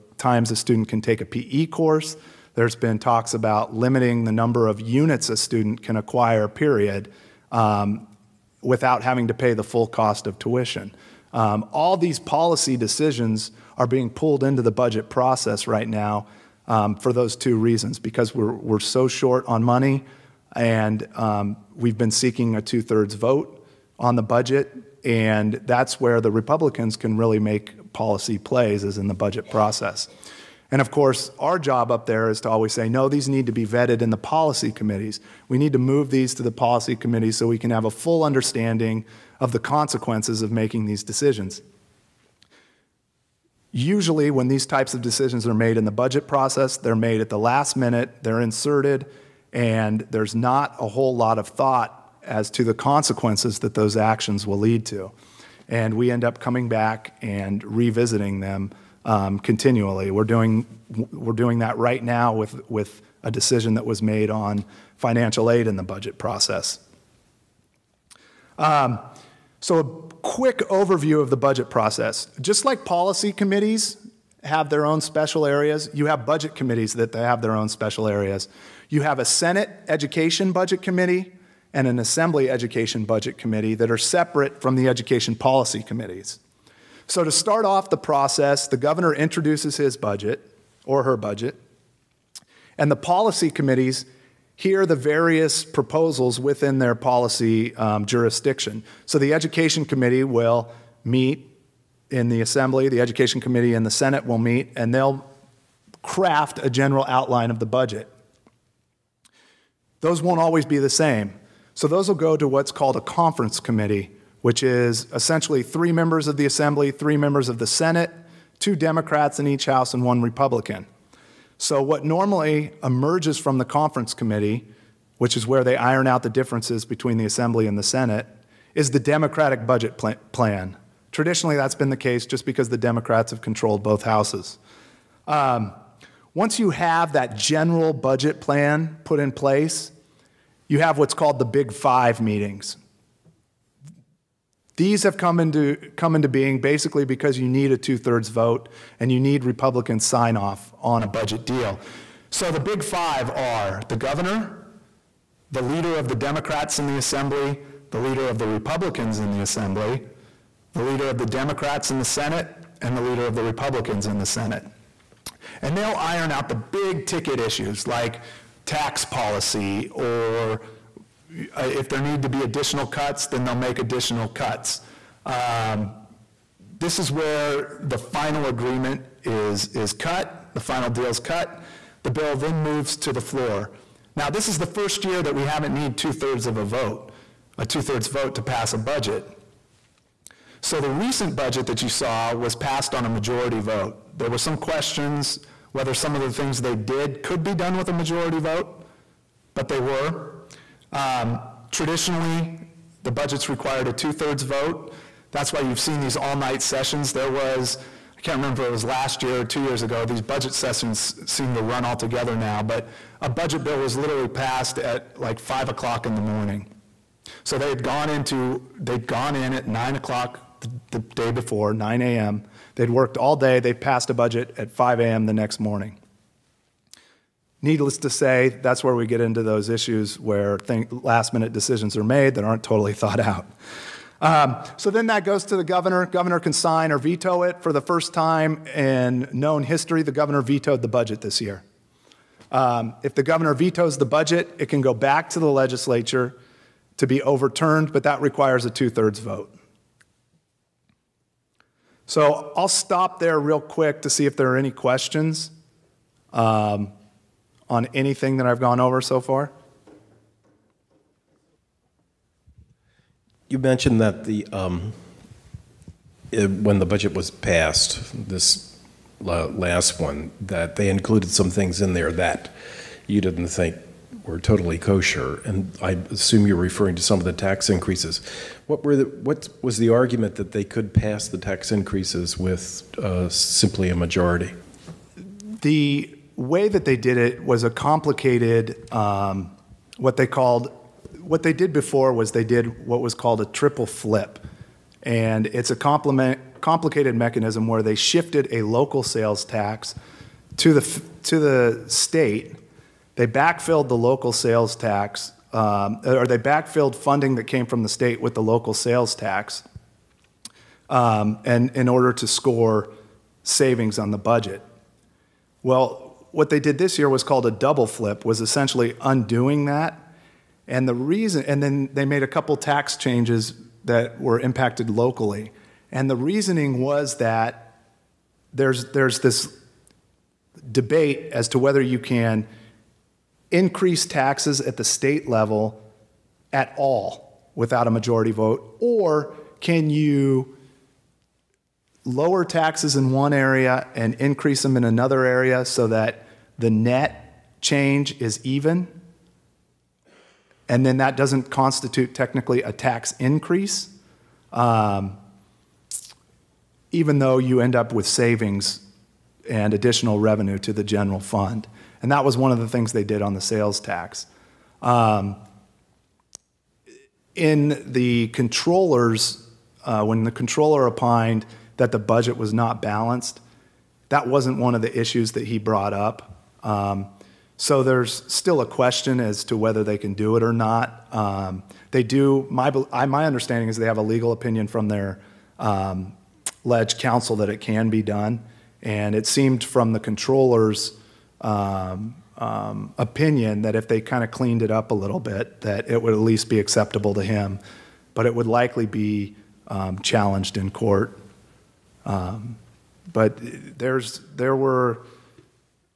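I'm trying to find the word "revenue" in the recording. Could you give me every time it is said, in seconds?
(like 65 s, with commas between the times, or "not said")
360 s.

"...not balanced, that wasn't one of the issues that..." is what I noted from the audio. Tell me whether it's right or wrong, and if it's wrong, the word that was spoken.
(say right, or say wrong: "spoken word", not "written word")
right.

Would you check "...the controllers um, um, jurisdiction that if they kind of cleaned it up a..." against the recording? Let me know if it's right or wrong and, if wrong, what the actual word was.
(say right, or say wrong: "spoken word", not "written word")
wrong: "opinion", not "jurisdiction".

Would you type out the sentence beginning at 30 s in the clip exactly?
And of course, our job up there is to always say, no, these need to be vetted in the policy committees.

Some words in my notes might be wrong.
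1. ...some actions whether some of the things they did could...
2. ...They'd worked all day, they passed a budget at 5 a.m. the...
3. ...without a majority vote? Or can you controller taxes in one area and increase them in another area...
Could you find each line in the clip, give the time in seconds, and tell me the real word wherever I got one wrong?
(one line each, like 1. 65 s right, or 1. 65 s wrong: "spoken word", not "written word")
1. 194 s wrong: "questions", not "actions"
2. 222 s right
3. 337 s wrong: "lower", not "controller".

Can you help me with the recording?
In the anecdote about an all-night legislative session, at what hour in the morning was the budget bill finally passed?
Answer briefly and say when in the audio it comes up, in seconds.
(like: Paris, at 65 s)
5 a.m., at 215 s.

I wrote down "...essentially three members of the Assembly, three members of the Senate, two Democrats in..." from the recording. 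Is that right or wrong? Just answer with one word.
right.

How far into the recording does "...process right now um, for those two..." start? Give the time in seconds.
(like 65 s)
15 s.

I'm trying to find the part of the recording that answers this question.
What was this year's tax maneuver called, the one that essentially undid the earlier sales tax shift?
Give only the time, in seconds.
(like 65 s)
317 s.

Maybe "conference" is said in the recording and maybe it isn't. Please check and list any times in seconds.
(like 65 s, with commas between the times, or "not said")
113 s, 123 s.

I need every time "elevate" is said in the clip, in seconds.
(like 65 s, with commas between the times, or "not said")
not said.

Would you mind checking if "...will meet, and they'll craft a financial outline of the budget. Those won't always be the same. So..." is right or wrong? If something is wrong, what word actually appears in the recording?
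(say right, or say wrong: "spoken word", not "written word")
wrong: "general", not "financial".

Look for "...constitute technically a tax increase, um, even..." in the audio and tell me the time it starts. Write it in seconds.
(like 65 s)
351 s.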